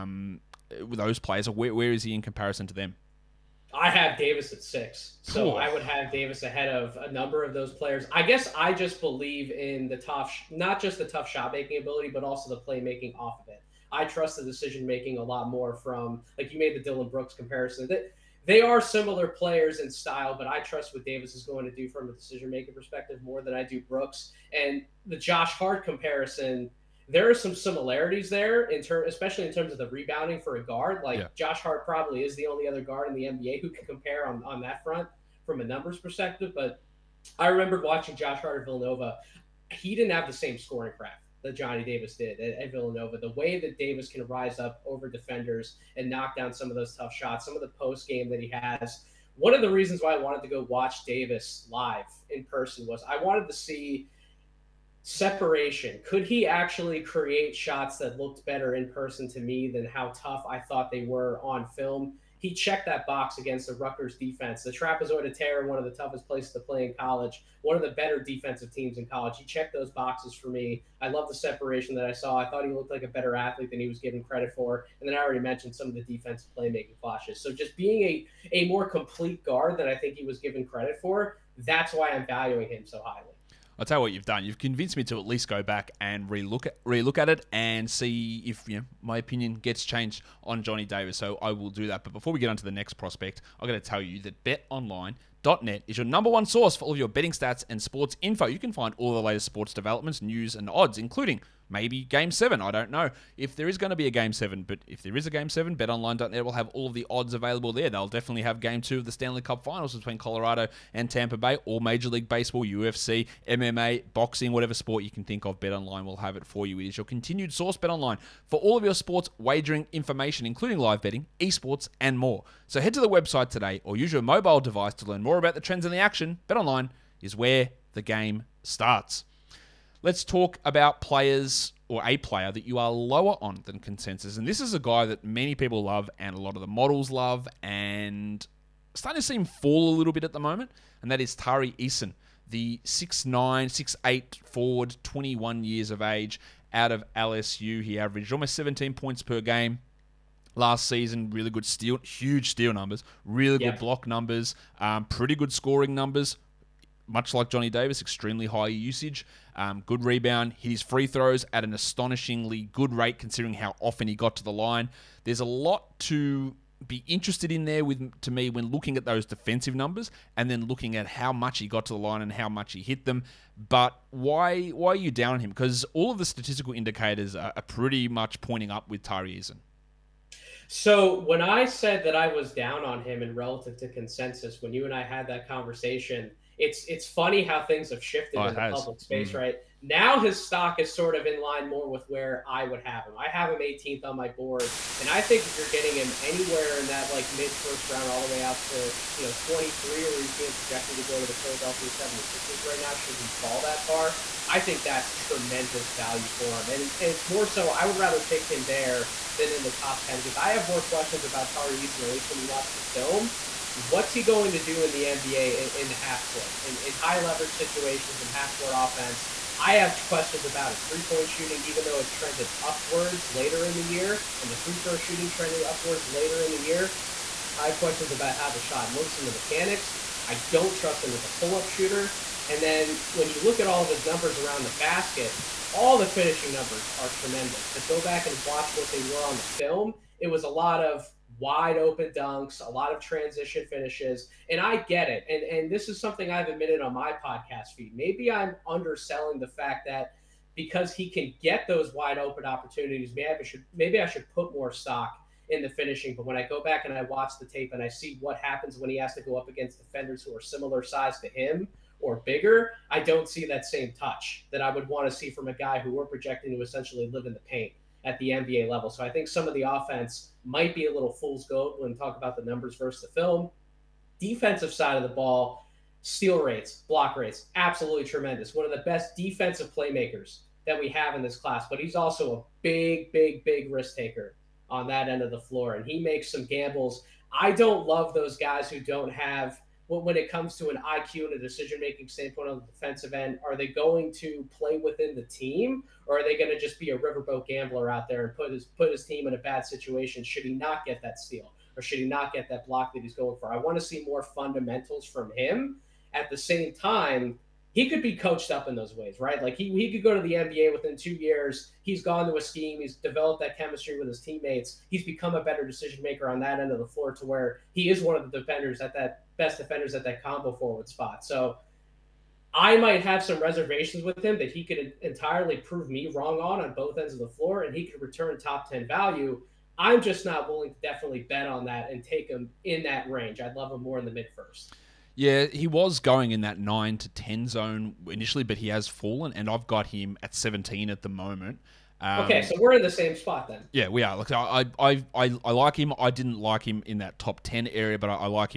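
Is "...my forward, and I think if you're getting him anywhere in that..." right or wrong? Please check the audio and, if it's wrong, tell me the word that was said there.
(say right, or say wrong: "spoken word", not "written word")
wrong: "board", not "forward".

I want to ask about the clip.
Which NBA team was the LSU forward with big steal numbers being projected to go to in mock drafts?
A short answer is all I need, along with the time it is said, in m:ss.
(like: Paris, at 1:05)
Philadelphia 76ers, at 3:21.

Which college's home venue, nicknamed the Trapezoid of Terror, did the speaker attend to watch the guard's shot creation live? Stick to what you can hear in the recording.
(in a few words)
Rutgers.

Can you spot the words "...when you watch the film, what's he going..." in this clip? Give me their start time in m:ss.
3:32.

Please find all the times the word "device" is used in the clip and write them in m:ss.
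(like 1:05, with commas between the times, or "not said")
2:04.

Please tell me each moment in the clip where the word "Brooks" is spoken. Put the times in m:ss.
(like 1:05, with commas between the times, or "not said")
0:17, 0:23.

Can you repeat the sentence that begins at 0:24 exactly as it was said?
And the Josh Hart comparison there are some similarities there in term, especially in terms of the rebounding for a guard.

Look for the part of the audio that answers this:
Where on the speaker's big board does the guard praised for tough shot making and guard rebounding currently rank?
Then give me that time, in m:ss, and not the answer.
0:04.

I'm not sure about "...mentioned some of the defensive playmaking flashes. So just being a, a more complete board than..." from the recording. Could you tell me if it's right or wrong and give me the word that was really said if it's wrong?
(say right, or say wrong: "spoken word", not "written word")
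wrong: "guard", not "board".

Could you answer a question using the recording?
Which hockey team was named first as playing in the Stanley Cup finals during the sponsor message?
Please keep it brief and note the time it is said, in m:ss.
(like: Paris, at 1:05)
Colorado, at 1:50.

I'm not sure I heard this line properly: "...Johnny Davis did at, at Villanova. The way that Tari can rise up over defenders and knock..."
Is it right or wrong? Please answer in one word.
wrong.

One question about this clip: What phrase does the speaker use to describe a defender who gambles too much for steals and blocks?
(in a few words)
riverboat gambler.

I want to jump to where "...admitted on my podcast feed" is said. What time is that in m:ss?
4:06.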